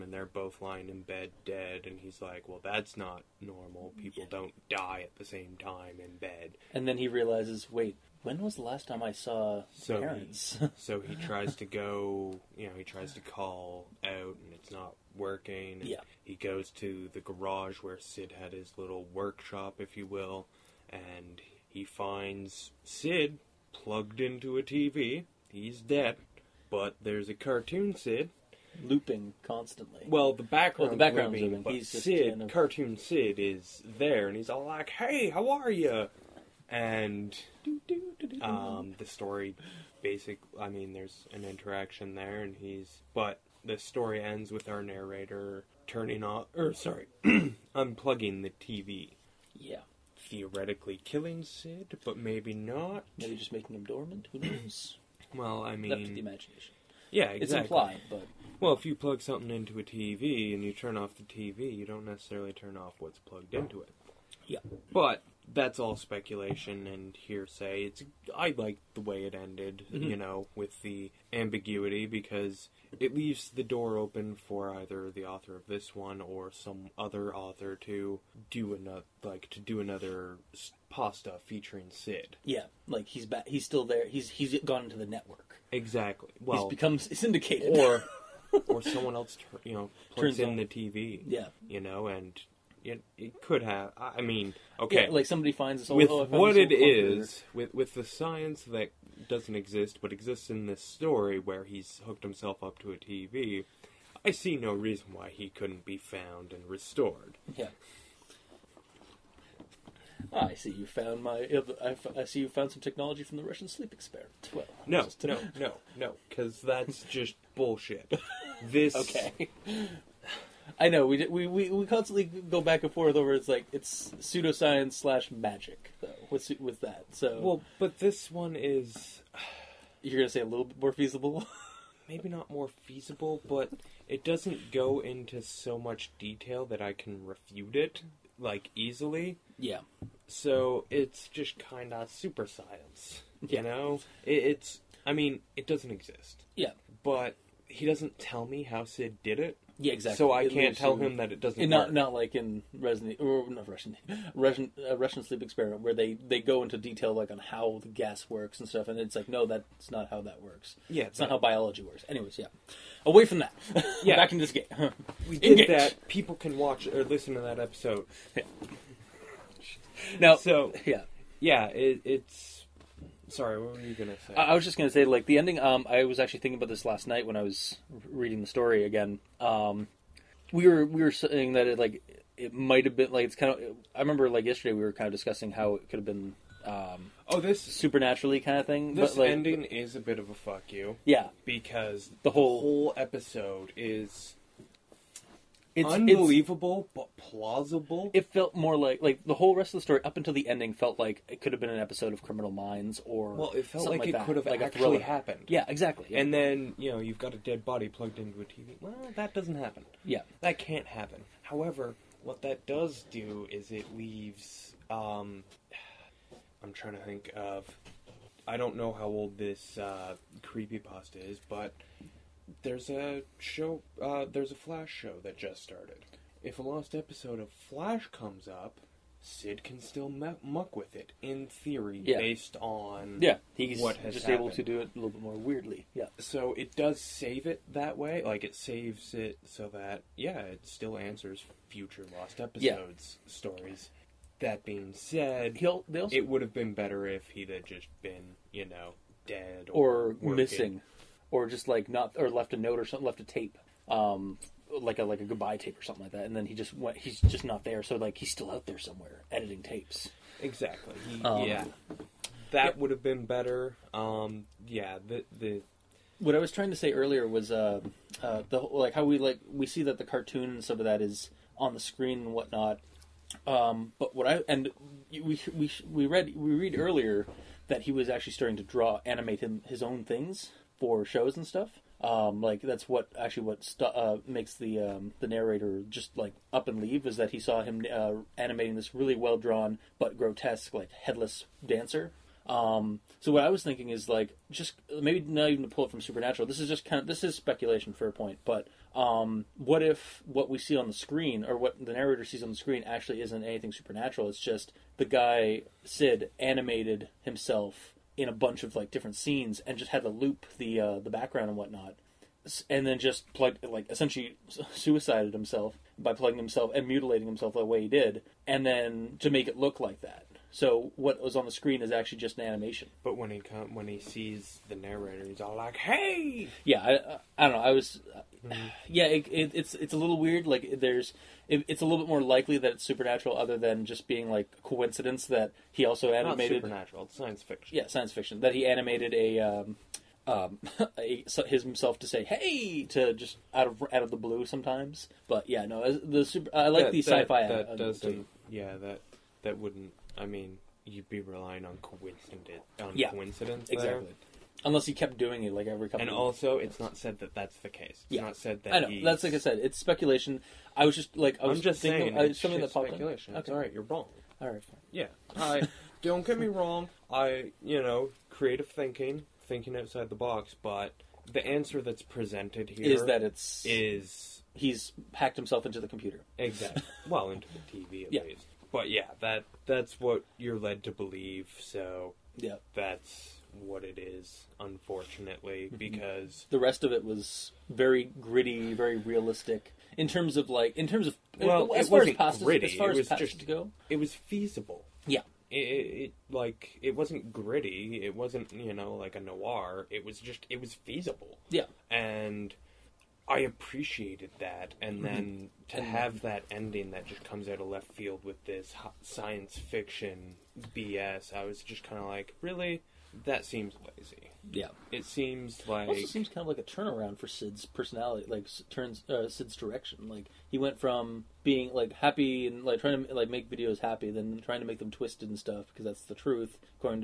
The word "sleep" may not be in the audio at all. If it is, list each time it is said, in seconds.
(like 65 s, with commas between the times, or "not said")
113 s, 155 s.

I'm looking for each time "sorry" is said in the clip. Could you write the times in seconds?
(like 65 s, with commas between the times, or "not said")
46 s, 173 s.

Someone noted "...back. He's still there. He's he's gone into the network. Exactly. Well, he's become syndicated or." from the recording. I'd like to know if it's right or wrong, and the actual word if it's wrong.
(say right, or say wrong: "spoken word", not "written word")
right.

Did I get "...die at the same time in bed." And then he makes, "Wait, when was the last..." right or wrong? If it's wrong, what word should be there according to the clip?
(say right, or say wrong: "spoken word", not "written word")
wrong: "realizes", not "makes".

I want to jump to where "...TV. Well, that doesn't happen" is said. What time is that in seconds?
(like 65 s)
208 s.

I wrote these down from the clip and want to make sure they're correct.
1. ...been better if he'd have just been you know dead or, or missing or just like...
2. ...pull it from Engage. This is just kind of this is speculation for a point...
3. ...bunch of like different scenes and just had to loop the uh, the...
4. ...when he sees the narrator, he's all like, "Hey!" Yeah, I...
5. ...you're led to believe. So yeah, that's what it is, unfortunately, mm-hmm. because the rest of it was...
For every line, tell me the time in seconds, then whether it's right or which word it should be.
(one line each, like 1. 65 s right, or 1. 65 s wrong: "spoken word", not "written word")
1. 246 s right
2. 295 s wrong: "Supernatural", not "Engage"
3. 308 s right
4. 323 s right
5. 380 s right.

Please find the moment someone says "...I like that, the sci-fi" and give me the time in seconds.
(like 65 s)
346 s.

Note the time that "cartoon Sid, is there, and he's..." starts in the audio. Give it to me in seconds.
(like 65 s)
32 s.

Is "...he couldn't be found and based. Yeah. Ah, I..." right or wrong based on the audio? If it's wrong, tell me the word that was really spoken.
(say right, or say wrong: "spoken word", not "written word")
wrong: "restored", not "based".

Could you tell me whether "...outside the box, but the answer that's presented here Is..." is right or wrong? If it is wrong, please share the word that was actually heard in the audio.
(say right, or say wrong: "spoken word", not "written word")
right.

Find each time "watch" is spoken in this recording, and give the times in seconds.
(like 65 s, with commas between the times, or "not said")
166 s.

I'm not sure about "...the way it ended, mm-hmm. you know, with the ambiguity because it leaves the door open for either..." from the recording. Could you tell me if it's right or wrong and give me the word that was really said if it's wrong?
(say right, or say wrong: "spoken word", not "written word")
right.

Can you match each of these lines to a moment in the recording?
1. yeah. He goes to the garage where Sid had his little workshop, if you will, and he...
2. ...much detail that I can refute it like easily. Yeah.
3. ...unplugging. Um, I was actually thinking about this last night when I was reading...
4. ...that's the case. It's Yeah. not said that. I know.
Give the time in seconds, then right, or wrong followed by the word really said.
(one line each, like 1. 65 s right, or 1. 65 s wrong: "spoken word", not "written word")
1. 15 s right
2. 135 s right
3. 175 s wrong: "ending", not "unplugging"
4. 357 s right.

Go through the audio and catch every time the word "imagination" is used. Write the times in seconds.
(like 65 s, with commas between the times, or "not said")
56 s.